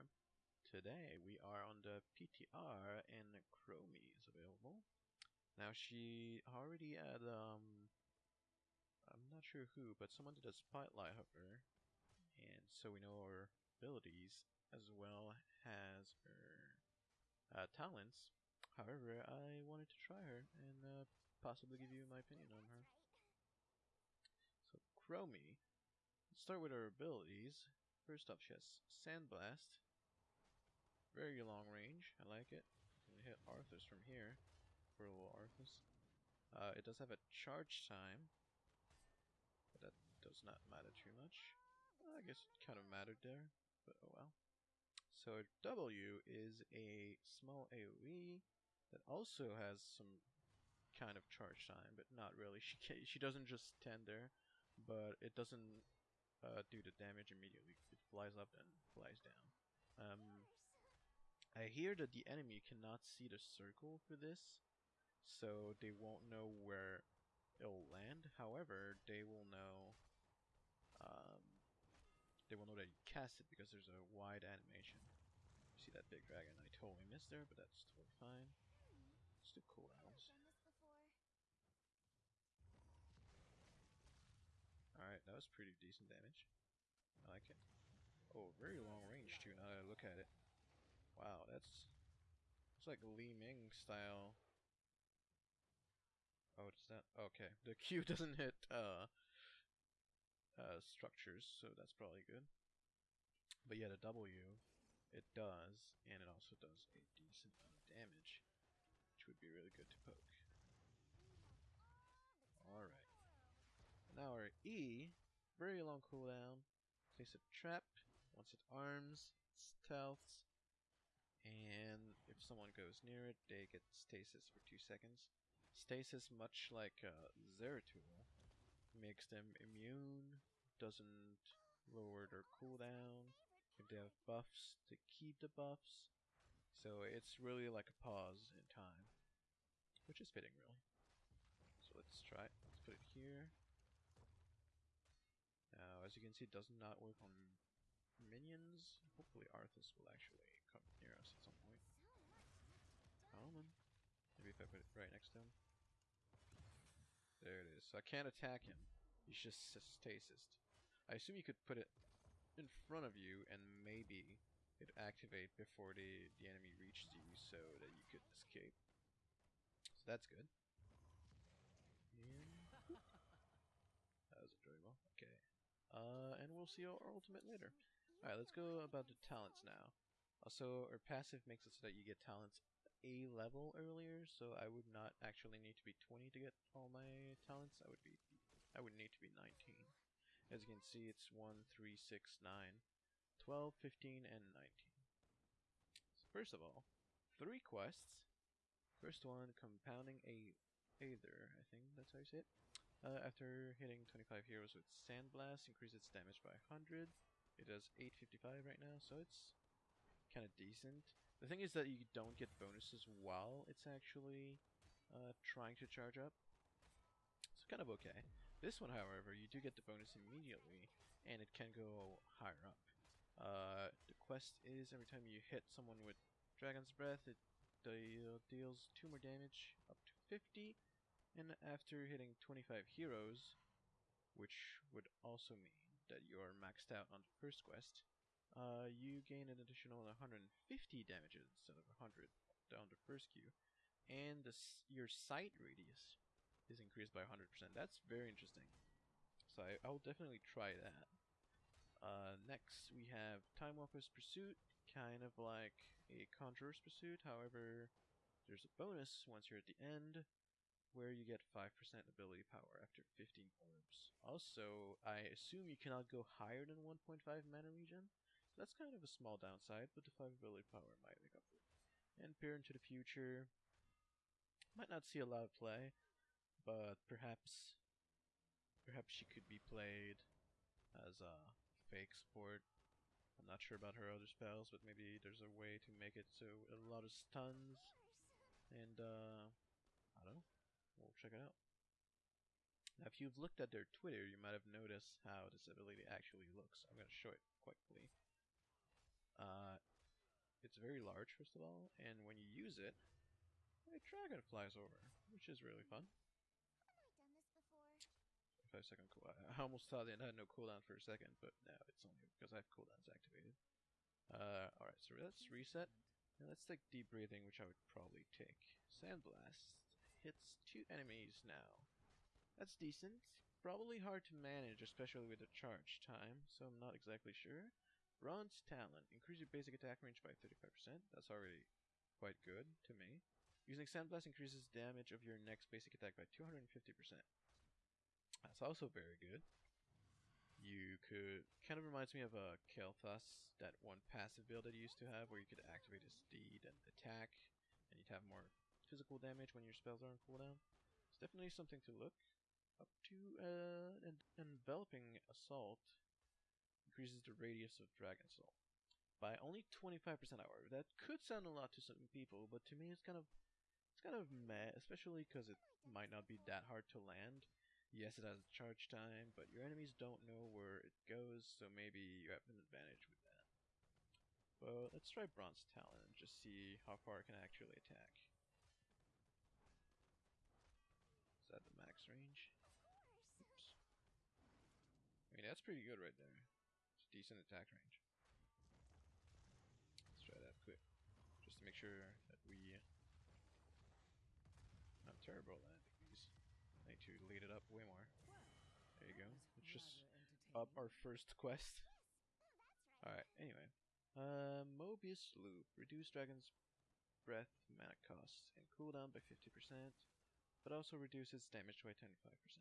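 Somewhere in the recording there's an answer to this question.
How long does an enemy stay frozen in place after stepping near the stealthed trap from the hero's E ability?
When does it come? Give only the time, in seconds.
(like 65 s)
124 s.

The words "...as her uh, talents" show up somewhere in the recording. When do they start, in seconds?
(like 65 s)
15 s.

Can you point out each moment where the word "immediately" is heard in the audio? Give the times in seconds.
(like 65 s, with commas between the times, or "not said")
57 s, 220 s.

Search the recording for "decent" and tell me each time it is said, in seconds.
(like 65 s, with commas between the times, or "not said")
85 s, 107 s, 210 s, 322 s, 387 s.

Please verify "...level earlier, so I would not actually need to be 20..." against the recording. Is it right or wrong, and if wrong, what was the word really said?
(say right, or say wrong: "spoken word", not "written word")
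right.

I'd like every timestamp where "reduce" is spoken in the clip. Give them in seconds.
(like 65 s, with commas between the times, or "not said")
405 s, 410 s.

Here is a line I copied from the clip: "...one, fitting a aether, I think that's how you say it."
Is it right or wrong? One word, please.
wrong.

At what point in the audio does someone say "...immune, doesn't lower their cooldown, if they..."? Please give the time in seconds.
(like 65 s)
129 s.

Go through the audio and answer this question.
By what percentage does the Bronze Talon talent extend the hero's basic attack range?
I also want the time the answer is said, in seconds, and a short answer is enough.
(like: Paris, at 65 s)
35%, at 330 s.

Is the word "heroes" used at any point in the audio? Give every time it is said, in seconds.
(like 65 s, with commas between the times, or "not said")
204 s, 232 s.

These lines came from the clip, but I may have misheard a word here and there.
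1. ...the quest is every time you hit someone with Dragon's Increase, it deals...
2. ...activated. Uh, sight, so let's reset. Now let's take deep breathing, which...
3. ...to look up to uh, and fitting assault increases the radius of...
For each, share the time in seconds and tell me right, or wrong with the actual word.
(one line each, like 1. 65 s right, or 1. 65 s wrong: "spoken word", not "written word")
1. 224 s wrong: "Breath", not "Increase"
2. 313 s wrong: "alright", not "sight"
3. 351 s wrong: "enveloping", not "fitting".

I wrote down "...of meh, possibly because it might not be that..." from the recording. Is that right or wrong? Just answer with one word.
wrong.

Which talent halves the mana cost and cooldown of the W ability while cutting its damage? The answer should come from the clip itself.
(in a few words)
Mobius Loop.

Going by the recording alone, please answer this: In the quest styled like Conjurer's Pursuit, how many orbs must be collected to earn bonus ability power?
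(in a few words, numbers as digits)
15.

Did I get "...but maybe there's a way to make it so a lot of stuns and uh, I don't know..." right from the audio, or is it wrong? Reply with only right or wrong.
right.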